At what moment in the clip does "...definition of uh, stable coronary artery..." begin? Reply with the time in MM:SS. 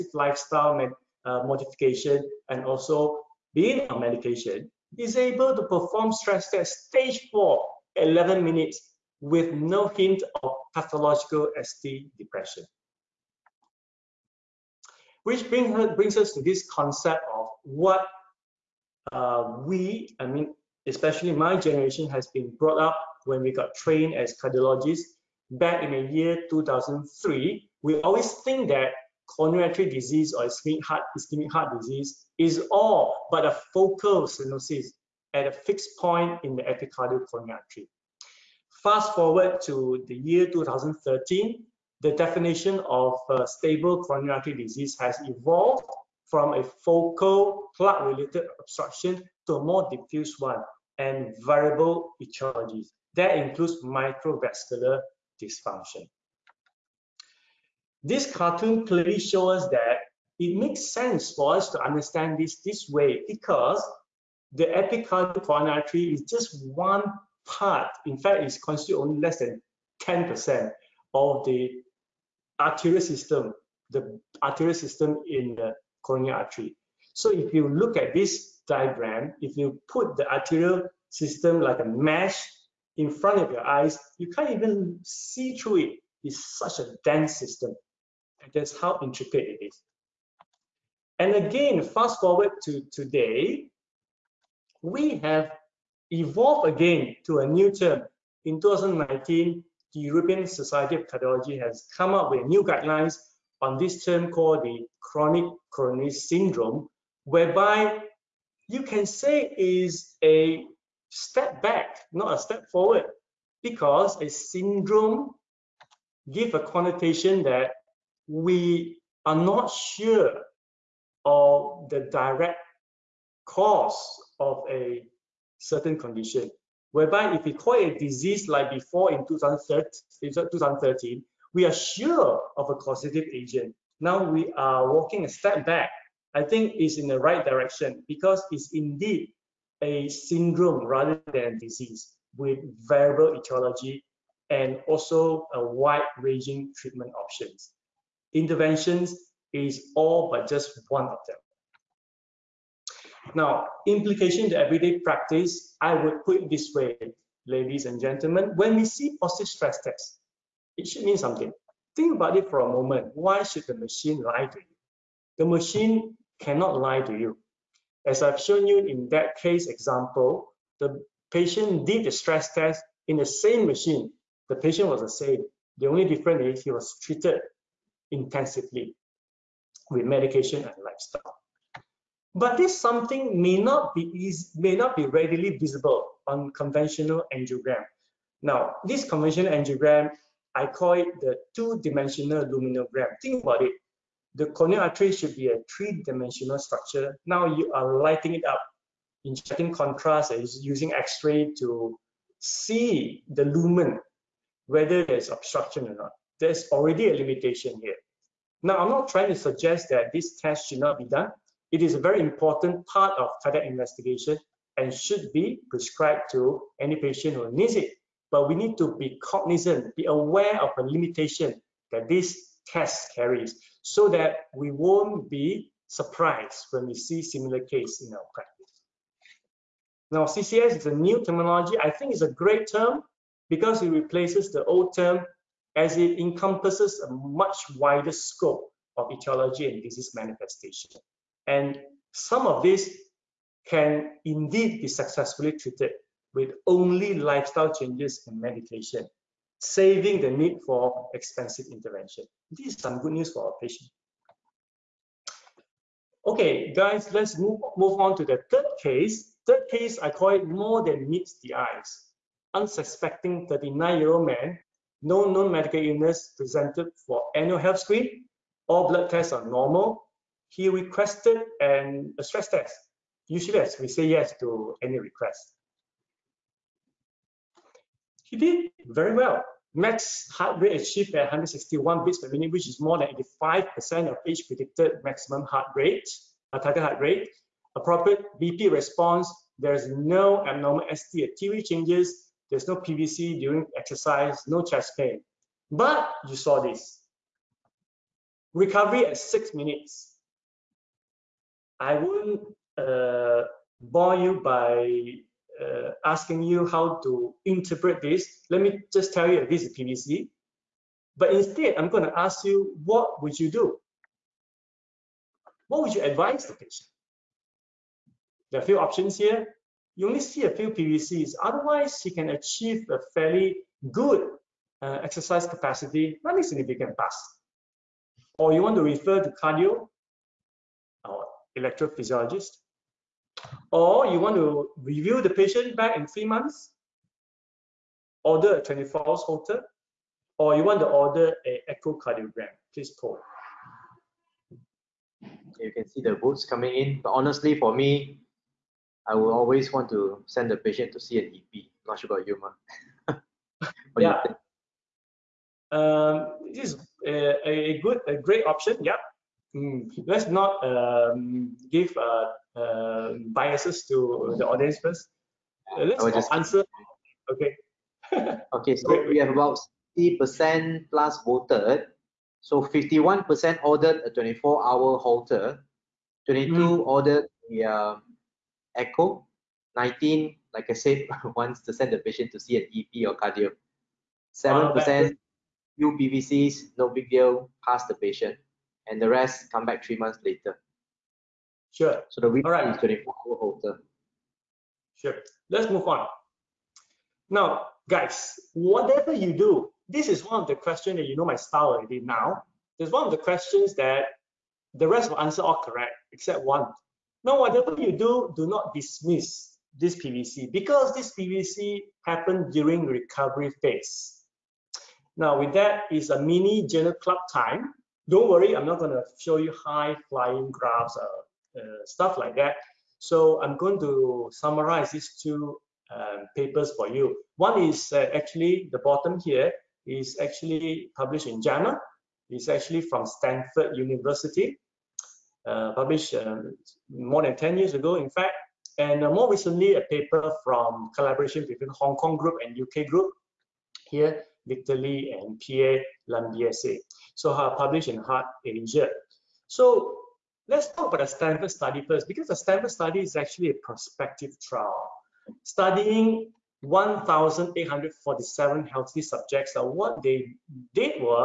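00:42.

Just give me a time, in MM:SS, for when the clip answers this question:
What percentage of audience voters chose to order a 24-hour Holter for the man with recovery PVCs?
06:12.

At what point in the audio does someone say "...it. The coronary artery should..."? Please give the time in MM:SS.
03:13.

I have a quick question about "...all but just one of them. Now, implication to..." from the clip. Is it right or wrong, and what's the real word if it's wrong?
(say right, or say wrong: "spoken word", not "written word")
right.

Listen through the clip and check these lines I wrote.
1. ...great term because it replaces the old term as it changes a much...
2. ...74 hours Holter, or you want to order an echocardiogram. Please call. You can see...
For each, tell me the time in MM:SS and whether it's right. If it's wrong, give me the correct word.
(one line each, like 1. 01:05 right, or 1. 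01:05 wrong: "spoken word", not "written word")
1. 03:52 wrong: "encompasses", not "changes"
2. 05:38 wrong: "24", not "74".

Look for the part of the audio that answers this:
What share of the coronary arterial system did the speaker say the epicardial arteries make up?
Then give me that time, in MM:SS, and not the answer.
01:09.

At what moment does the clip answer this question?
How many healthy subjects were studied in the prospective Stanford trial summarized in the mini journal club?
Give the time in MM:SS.
07:36.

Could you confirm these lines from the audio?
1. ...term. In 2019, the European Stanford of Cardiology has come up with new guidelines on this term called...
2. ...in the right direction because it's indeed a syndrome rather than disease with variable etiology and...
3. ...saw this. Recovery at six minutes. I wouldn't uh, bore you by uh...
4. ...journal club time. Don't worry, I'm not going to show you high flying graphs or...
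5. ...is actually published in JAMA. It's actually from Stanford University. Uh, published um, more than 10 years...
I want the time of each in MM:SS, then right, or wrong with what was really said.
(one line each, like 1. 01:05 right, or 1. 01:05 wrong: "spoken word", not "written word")
1. 01:37 wrong: "Society", not "Stanford"
2. 02:16 right
3. 04:56 right
4. 06:56 right
5. 07:09 right.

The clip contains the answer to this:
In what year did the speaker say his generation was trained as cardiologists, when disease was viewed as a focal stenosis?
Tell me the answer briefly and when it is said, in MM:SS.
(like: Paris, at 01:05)
2003, at 00:26.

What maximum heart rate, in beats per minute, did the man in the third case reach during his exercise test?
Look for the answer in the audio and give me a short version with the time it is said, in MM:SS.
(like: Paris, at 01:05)
161, at 04:41.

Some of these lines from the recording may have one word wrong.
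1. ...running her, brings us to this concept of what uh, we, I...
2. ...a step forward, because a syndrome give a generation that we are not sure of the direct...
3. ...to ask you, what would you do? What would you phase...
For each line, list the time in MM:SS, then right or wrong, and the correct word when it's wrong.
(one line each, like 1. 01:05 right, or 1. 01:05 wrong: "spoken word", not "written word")
1. 00:15 wrong: "bring", not "running"
2. 01:52 wrong: "connotation", not "generation"
3. 05:12 wrong: "advise", not "phase".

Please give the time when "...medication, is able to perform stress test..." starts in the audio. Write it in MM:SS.
00:03.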